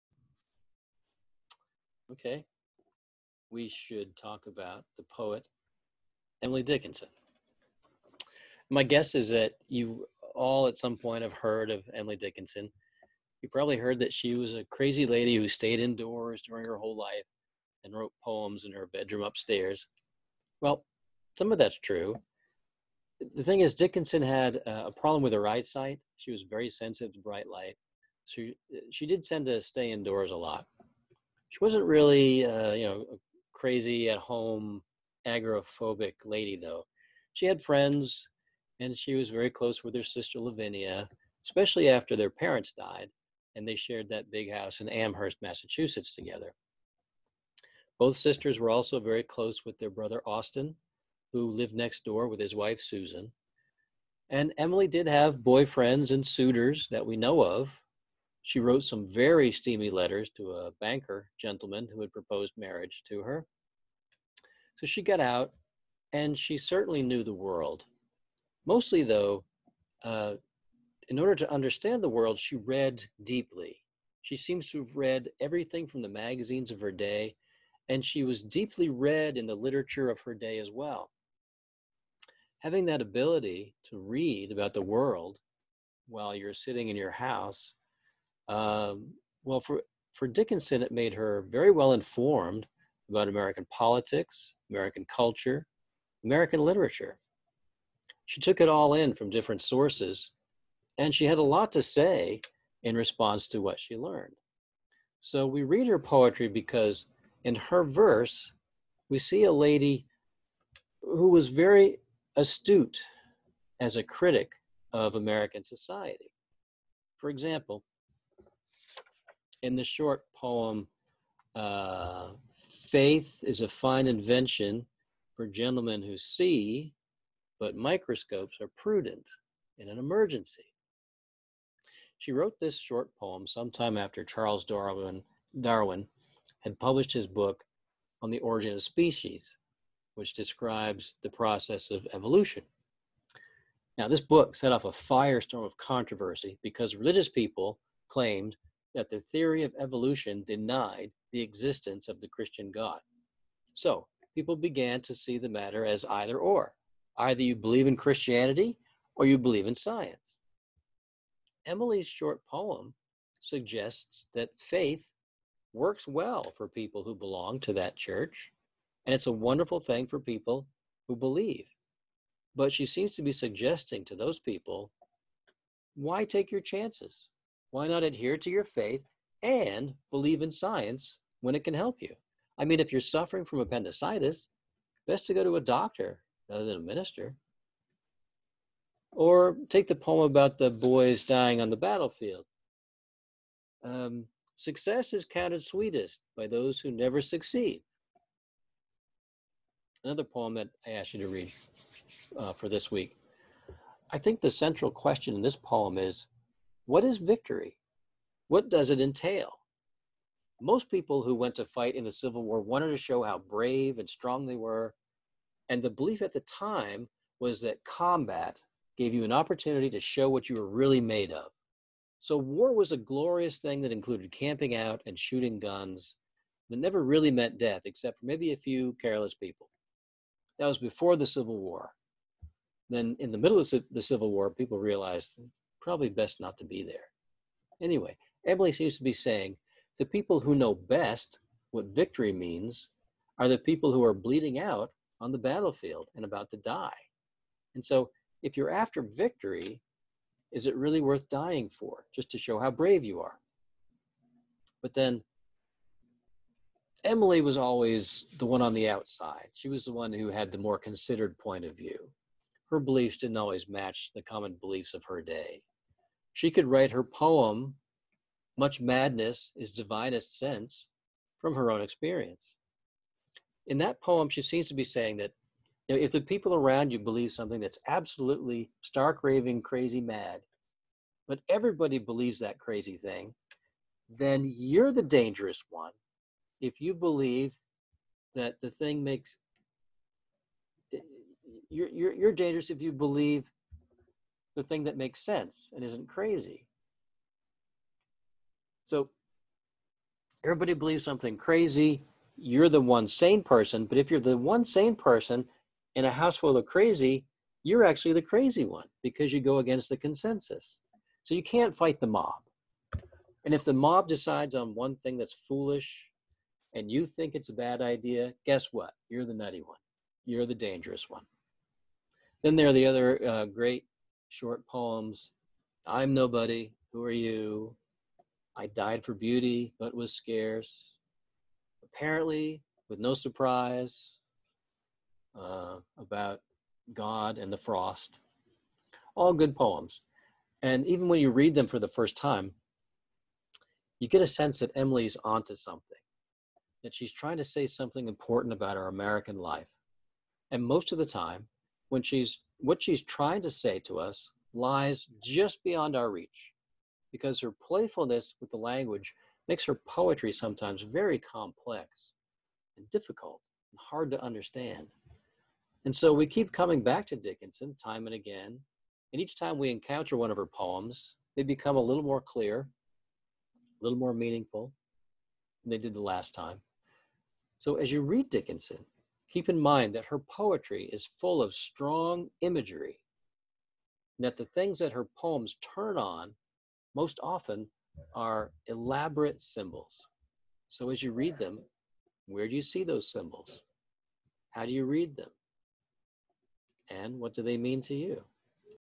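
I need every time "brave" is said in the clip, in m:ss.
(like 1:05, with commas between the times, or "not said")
3:33, 4:12.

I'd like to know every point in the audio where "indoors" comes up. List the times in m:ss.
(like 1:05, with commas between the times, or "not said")
0:15, 0:29.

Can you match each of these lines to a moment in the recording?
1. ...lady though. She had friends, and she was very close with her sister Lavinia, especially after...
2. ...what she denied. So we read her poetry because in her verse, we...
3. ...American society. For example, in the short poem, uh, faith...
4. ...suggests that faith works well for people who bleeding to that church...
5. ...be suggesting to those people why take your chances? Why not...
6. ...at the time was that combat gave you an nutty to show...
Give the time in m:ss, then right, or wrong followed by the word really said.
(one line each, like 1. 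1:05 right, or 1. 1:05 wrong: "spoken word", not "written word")
1. 0:36 right
2. 1:43 wrong: "learned", not "denied"
3. 1:55 right
4. 2:43 wrong: "belong", not "bleeding"
5. 2:53 right
6. 3:36 wrong: "opportunity", not "nutty".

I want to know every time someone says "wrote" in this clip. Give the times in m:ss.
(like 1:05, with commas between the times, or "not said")
0:17, 0:58, 2:12.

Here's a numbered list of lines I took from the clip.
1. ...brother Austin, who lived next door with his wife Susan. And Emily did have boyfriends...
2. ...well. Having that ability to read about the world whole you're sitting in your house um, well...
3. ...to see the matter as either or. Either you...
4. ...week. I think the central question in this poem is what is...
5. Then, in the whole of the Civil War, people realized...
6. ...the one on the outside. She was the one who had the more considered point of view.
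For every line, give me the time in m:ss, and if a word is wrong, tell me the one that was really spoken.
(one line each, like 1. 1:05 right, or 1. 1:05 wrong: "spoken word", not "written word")
1. 0:49 right
2. 1:20 wrong: "while", not "whole"
3. 2:35 right
4. 3:22 right
5. 3:52 wrong: "middle", not "whole"
6. 4:18 right.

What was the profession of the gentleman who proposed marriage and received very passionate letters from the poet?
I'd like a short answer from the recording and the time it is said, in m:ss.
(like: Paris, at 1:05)
banker, at 1:00.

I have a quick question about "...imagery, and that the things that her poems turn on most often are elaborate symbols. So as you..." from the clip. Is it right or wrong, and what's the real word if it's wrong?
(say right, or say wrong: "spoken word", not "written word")
right.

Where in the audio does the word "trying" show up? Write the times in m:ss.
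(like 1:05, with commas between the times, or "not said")
5:47, 5:53.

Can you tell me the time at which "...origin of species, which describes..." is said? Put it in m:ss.
2:18.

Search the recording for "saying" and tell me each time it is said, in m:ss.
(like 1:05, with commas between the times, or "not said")
3:59, 4:34.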